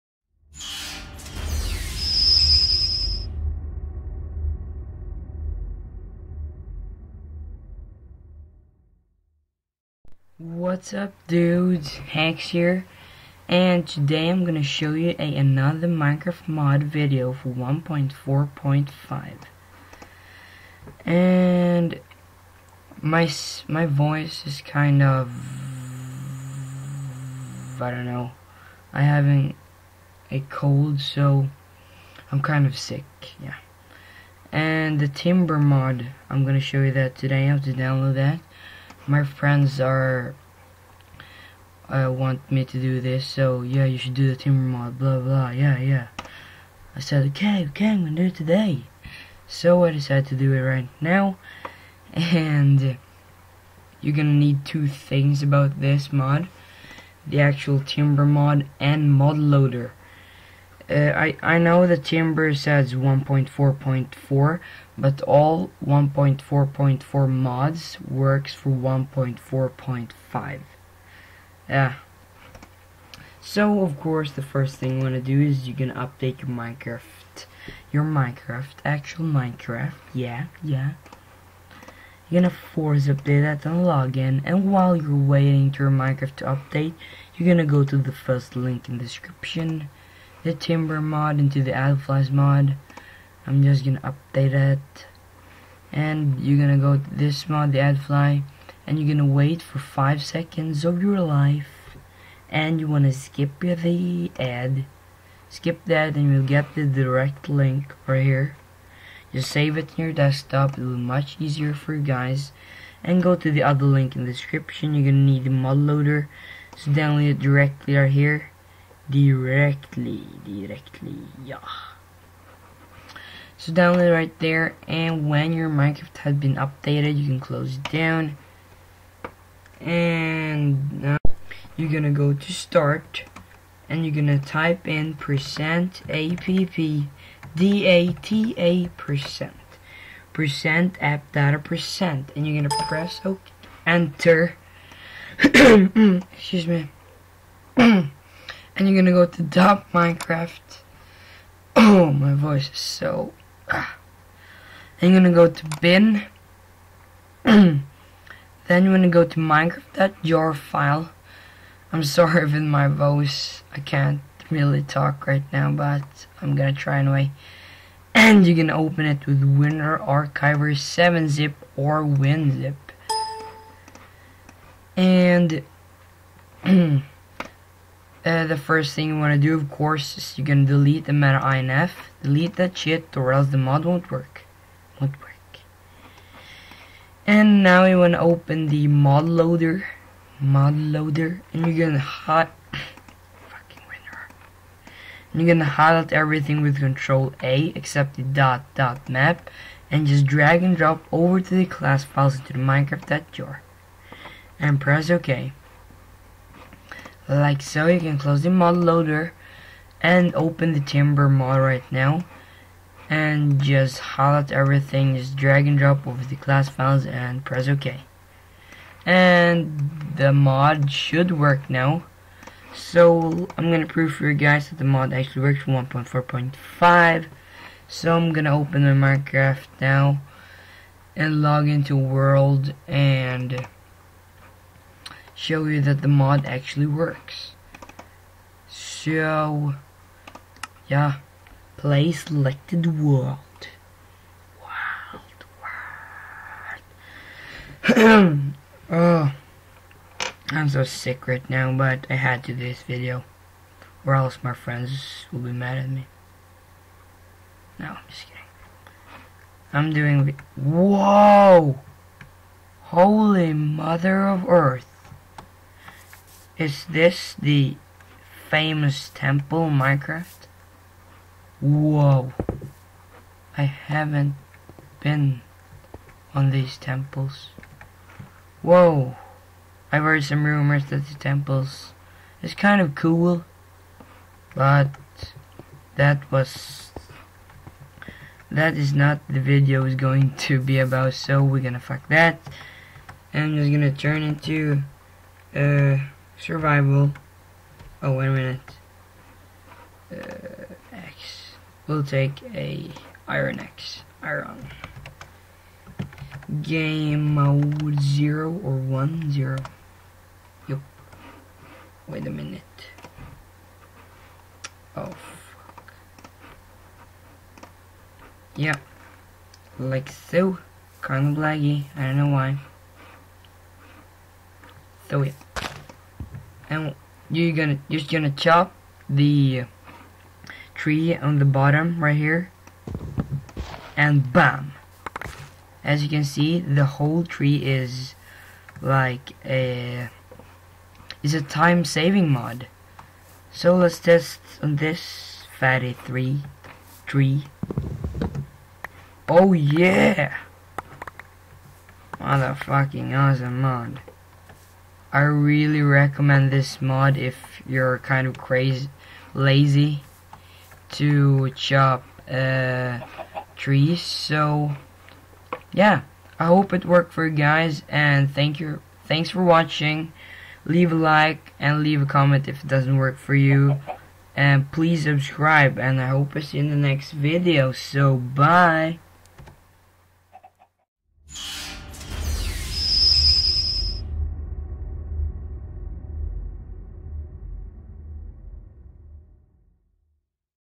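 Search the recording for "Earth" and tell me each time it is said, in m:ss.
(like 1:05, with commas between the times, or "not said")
4:24.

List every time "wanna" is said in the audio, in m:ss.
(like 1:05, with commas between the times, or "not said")
1:42.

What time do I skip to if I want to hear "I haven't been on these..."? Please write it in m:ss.
4:33.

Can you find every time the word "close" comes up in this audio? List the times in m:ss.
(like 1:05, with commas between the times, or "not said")
2:07, 3:28.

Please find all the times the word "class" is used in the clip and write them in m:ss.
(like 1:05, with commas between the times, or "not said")
3:21, 3:36.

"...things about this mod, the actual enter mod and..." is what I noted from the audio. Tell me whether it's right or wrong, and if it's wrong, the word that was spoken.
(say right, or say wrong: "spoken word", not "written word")
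wrong: "timber", not "enter".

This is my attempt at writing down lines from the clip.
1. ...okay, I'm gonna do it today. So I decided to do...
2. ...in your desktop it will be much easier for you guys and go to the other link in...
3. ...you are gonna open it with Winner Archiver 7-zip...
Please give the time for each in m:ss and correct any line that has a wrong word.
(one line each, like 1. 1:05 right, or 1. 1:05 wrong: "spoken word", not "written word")
1. 0:47 right
2. 1:49 right
3. 2:48 right.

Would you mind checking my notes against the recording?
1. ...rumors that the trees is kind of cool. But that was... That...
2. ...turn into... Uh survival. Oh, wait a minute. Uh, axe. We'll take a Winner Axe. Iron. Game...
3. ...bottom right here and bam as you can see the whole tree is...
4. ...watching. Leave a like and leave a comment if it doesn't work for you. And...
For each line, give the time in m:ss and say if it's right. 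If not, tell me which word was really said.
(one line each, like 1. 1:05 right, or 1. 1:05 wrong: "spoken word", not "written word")
1. 4:40 wrong: "temples", not "trees"
2. 4:53 wrong: "Iron", not "Winner"
3. 5:31 right
4. 6:09 right.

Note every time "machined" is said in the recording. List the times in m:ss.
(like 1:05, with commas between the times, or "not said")
not said.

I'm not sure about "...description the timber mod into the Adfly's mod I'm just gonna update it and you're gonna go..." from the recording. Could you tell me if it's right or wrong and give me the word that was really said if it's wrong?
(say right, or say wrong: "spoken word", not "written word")
right.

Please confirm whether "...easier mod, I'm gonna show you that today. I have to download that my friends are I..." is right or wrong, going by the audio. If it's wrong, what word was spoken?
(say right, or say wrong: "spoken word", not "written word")
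wrong: "timber", not "easier".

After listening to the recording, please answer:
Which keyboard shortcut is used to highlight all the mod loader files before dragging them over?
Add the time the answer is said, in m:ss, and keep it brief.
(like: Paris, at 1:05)
Control A, at 3:16.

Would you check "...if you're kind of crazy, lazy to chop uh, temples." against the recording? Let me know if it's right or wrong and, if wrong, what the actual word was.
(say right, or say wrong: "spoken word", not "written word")
wrong: "trees", not "temples".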